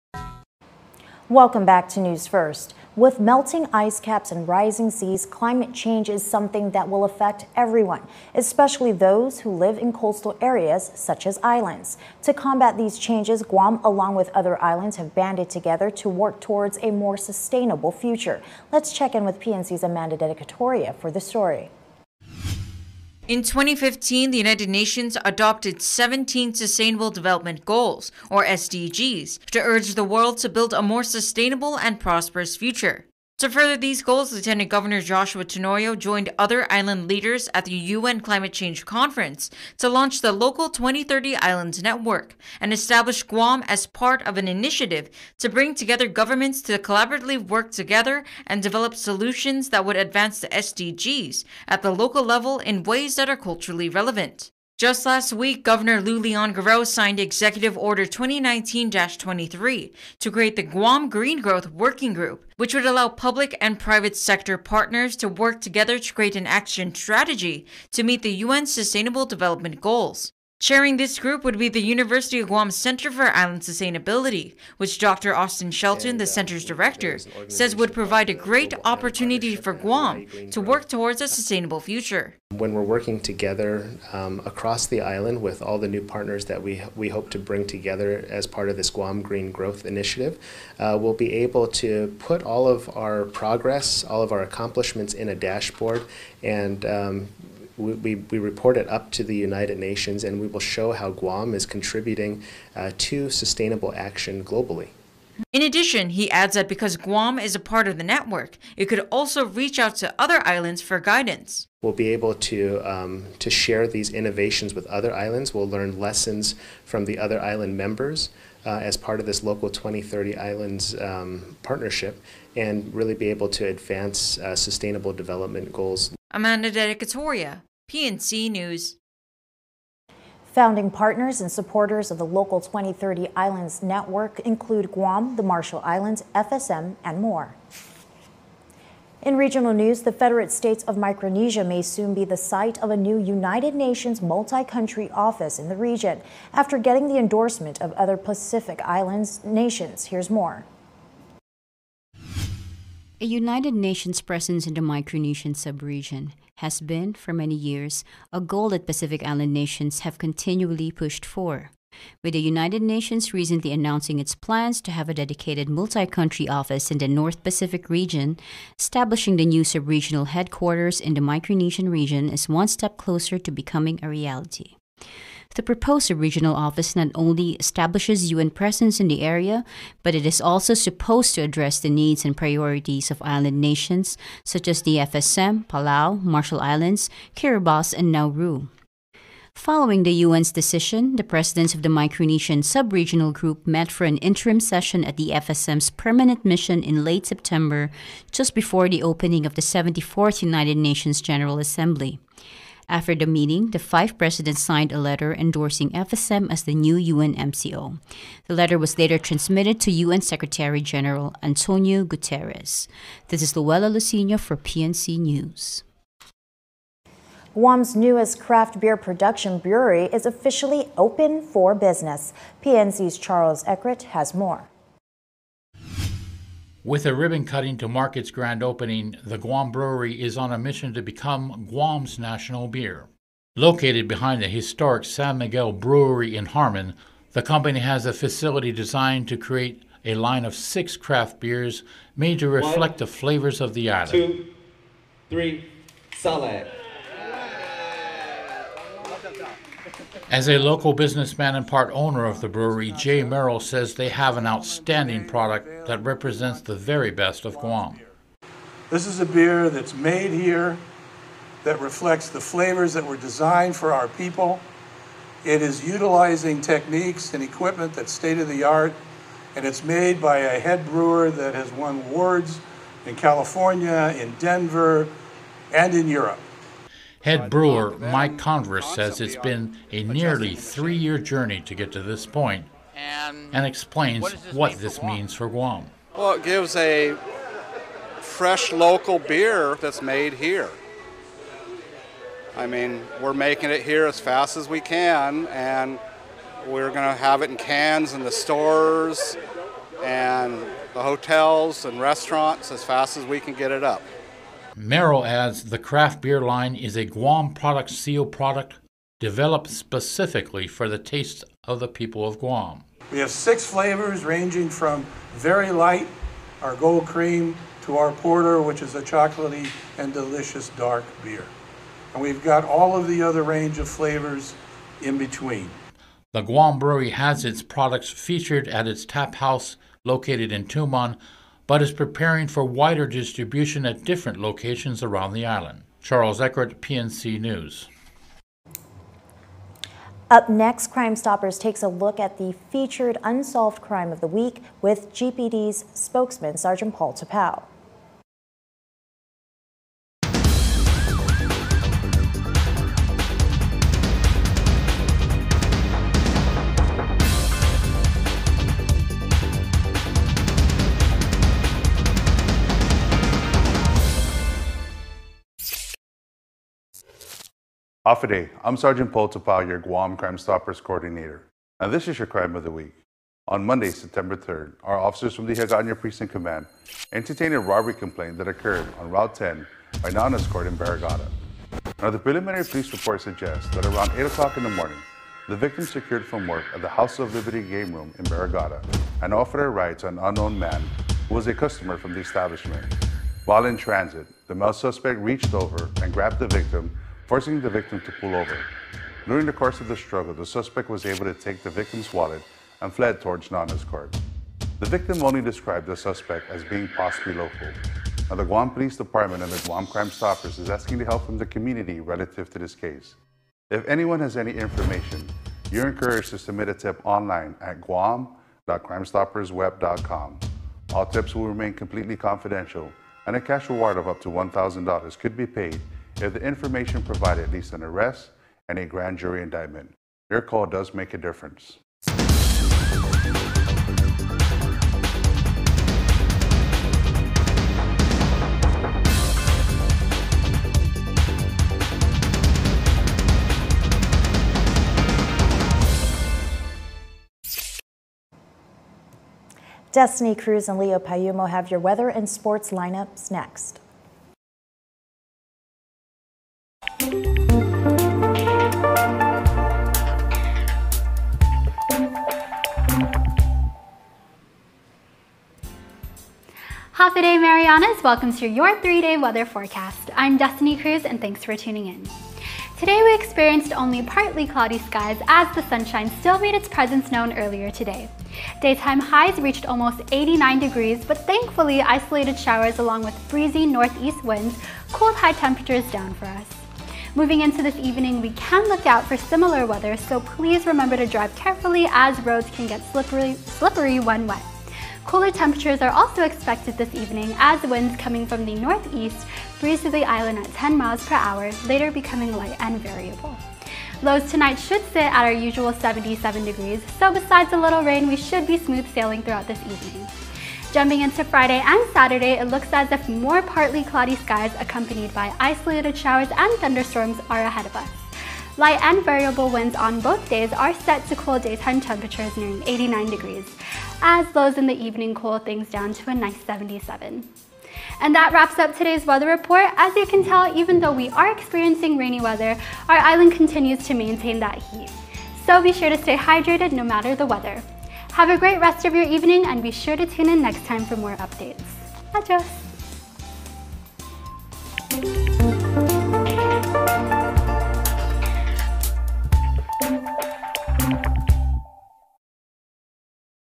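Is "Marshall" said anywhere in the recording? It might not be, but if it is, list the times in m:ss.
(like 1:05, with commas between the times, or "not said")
2:15, 3:06.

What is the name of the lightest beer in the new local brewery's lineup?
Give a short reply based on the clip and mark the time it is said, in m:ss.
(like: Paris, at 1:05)
Gold cream, at 5:16.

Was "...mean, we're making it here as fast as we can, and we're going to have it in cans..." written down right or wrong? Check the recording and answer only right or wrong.
right.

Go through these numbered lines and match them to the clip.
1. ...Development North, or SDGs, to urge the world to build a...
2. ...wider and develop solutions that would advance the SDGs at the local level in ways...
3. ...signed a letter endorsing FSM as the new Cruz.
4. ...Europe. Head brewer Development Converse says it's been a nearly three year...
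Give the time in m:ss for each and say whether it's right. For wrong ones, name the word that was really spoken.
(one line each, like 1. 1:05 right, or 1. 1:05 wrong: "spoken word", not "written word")
1. 0:27 wrong: "Goals", not "North"
2. 0:47 wrong: "together", not "wider"
3. 3:24 wrong: "UNMCO", not "Cruz"
4. 4:36 wrong: "Mike", not "Development".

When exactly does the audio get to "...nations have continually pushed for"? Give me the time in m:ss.
2:39.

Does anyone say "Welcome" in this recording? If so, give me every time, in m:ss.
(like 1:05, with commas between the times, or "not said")
0:01, 7:48.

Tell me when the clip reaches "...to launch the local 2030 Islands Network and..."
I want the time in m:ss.
0:39.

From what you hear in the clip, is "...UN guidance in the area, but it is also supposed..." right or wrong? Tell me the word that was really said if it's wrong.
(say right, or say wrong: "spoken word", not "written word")
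wrong: "presence", not "guidance".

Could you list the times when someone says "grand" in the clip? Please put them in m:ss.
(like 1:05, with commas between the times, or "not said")
3:48, 7:08.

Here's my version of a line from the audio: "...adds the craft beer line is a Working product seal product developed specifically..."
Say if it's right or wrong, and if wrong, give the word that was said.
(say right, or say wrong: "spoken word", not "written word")
wrong: "Guam", not "Working".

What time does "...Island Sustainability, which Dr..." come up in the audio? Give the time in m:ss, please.
1:13.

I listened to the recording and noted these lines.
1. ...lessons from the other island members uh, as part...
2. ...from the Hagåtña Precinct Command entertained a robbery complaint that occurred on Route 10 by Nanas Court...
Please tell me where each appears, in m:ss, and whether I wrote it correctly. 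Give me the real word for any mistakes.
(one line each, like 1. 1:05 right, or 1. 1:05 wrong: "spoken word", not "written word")
1. 1:55 right
2. 6:15 right.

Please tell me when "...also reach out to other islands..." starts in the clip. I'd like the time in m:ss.
1:49.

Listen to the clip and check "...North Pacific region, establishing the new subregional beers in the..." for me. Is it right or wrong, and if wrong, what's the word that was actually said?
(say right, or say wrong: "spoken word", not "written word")
wrong: "headquarters", not "beers".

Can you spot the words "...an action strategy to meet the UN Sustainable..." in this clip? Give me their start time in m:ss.
1:06.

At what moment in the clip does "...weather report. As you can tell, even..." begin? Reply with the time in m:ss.
8:49.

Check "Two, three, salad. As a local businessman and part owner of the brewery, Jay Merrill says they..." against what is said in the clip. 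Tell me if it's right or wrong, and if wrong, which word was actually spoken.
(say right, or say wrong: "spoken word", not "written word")
right.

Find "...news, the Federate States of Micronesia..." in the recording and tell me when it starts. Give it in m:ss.
2:19.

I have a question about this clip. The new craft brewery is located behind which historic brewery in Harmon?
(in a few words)
San Miguel Brewery.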